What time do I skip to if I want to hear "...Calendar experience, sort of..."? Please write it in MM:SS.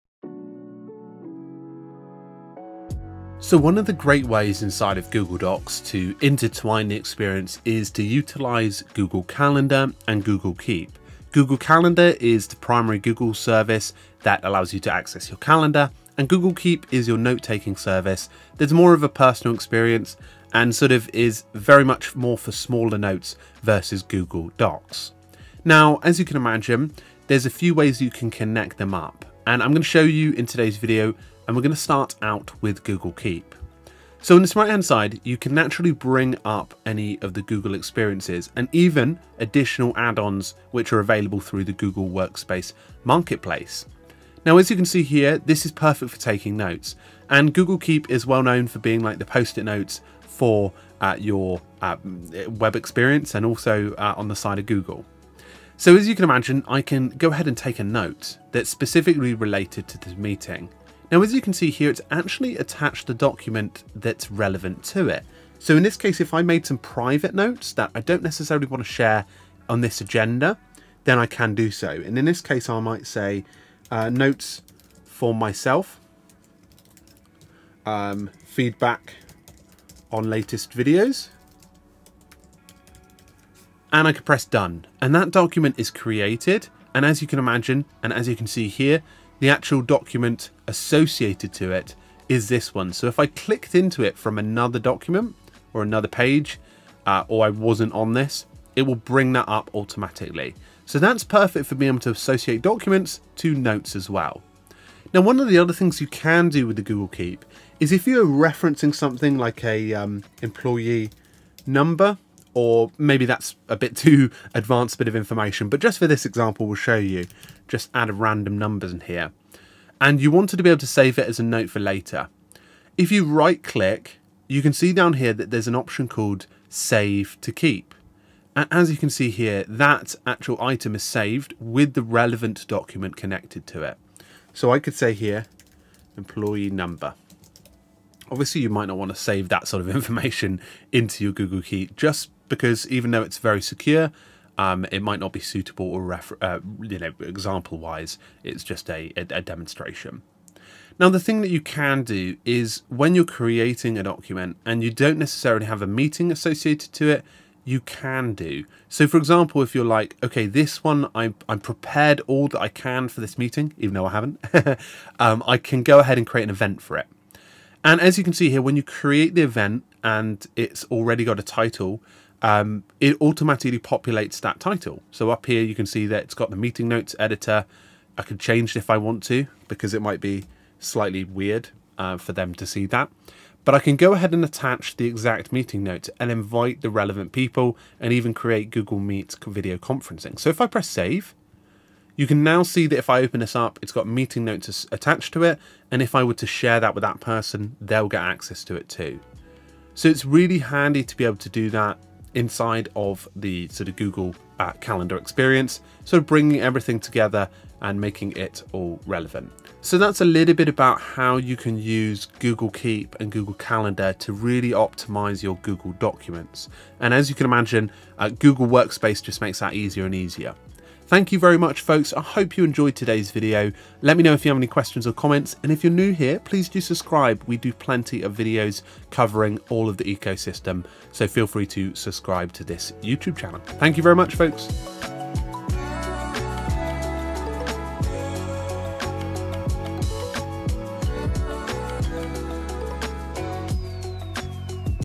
03:24.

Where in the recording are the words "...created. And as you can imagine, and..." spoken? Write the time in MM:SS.
01:25.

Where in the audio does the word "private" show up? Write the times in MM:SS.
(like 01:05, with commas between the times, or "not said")
01:06.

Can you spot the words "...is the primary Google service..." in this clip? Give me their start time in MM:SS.
00:12.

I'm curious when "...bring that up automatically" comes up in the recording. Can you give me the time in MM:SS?
01:38.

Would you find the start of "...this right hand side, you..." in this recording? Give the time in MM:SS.
00:34.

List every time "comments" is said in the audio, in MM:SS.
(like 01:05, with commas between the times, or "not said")
03:45.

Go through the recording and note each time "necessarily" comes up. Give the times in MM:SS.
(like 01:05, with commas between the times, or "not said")
01:08, 02:35.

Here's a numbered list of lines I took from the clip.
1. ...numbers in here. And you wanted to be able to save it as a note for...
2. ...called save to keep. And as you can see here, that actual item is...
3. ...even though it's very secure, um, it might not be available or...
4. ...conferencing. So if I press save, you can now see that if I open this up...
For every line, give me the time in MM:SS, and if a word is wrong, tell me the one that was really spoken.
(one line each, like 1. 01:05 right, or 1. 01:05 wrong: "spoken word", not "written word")
1. 01:58 right
2. 02:06 right
3. 02:22 wrong: "suitable", not "available"
4. 03:09 right.